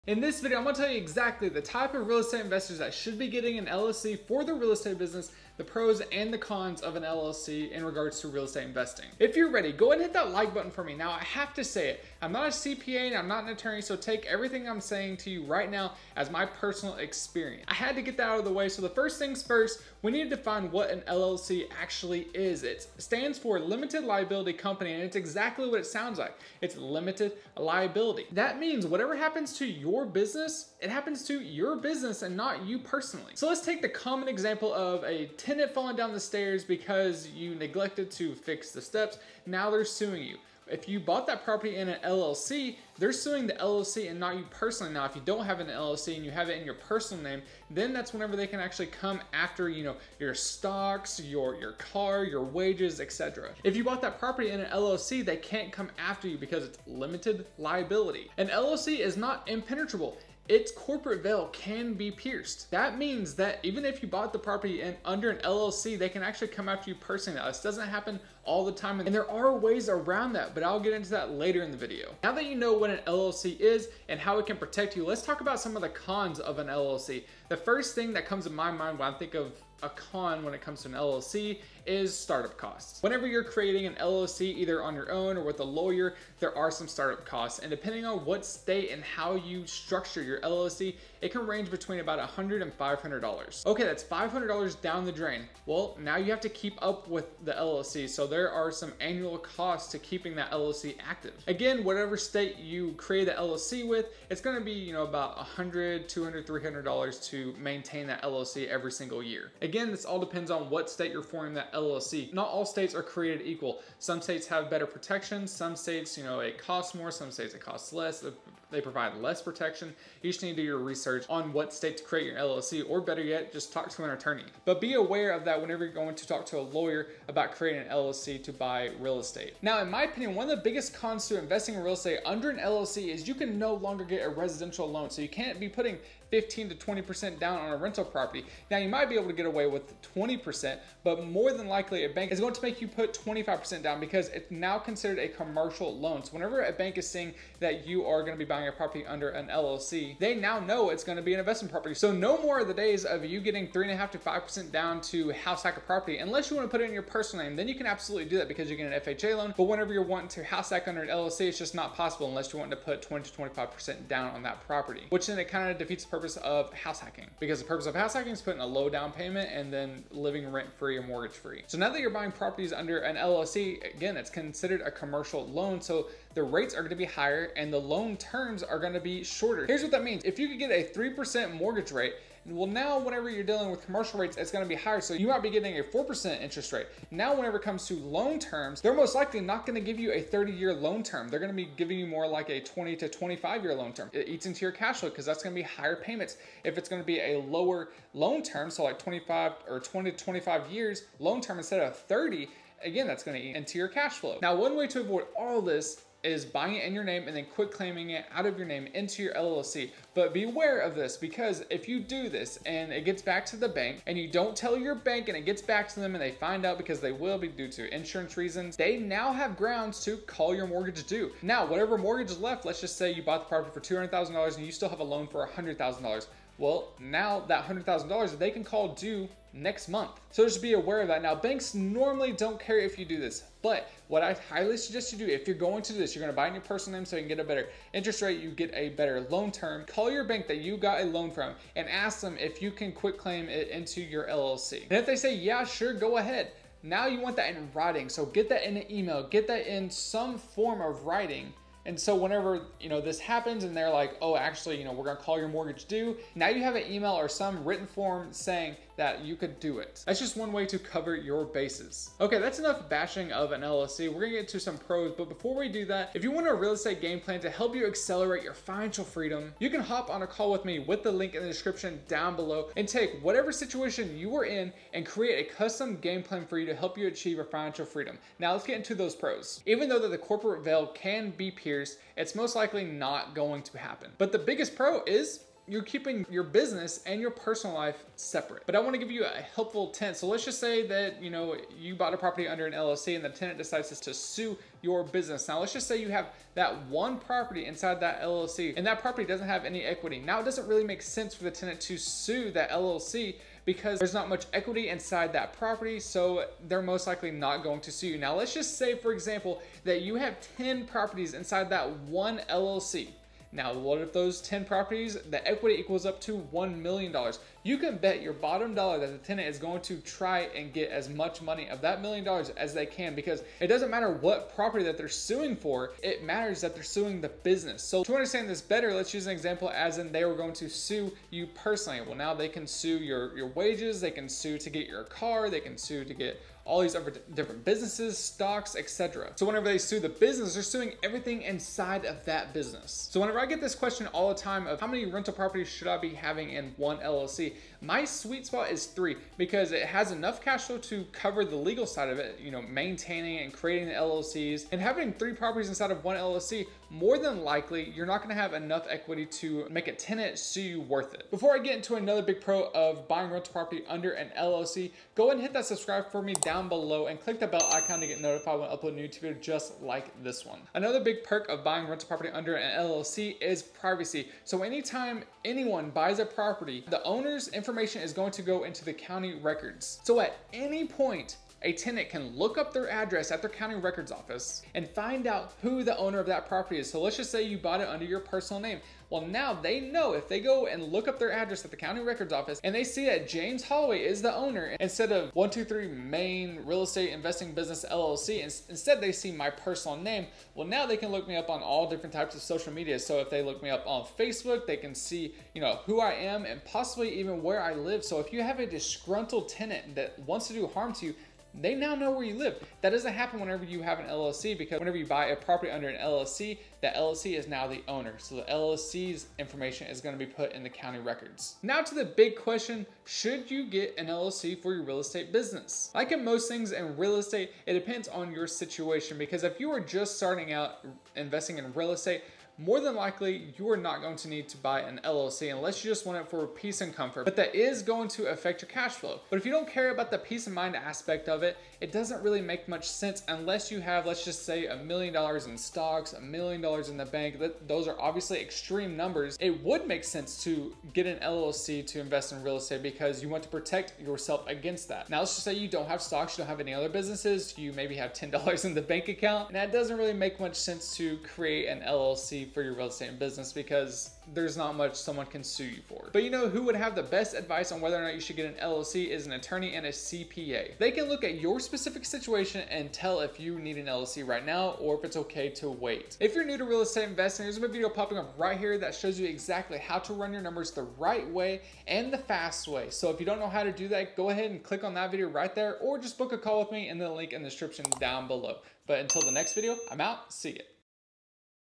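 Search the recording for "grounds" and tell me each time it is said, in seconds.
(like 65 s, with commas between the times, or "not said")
219 s.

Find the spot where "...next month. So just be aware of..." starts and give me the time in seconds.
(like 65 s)
229 s.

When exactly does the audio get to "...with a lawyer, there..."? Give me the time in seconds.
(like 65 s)
85 s.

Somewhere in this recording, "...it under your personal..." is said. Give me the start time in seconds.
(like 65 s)
387 s.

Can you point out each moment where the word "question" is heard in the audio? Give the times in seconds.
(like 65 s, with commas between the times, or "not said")
343 s, 422 s.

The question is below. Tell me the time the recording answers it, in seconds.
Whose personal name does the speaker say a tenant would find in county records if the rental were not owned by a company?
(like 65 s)
393 s.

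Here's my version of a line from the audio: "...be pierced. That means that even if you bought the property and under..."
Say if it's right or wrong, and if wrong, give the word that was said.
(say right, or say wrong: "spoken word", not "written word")
right.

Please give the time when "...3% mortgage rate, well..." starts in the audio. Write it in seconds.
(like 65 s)
180 s.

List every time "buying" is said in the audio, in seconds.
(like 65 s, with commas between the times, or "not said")
148 s, 172 s, 206 s, 363 s, 371 s.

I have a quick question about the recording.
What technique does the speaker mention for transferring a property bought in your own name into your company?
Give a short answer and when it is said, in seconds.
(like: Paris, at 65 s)
quit claiming, at 207 s.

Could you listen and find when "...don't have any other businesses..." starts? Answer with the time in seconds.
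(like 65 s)
456 s.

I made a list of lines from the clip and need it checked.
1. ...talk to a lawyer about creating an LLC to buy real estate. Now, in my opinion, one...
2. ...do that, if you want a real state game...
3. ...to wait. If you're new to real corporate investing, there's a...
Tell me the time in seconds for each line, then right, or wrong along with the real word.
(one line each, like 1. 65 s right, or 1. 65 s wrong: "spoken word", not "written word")
1. 126 s right
2. 265 s wrong: "estate", not "state"
3. 475 s wrong: "estate", not "corporate".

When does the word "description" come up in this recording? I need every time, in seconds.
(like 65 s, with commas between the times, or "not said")
271 s, 487 s.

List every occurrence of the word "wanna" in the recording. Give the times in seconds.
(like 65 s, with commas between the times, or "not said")
156 s, 288 s.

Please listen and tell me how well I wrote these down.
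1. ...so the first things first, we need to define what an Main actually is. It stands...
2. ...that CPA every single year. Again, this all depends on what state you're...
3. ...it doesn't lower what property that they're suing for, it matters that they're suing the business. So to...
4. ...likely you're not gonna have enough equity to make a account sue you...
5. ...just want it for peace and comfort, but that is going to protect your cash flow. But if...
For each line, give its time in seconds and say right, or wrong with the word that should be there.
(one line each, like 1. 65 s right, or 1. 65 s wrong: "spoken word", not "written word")
1. 18 s wrong: "LLC", not "Main"
2. 108 s wrong: "LLC", not "CPA"
3. 323 s wrong: "matter", not "lower"
4. 357 s wrong: "tenant", not "account"
5. 435 s wrong: "affect", not "protect".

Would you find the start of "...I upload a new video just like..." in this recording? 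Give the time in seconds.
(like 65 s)
368 s.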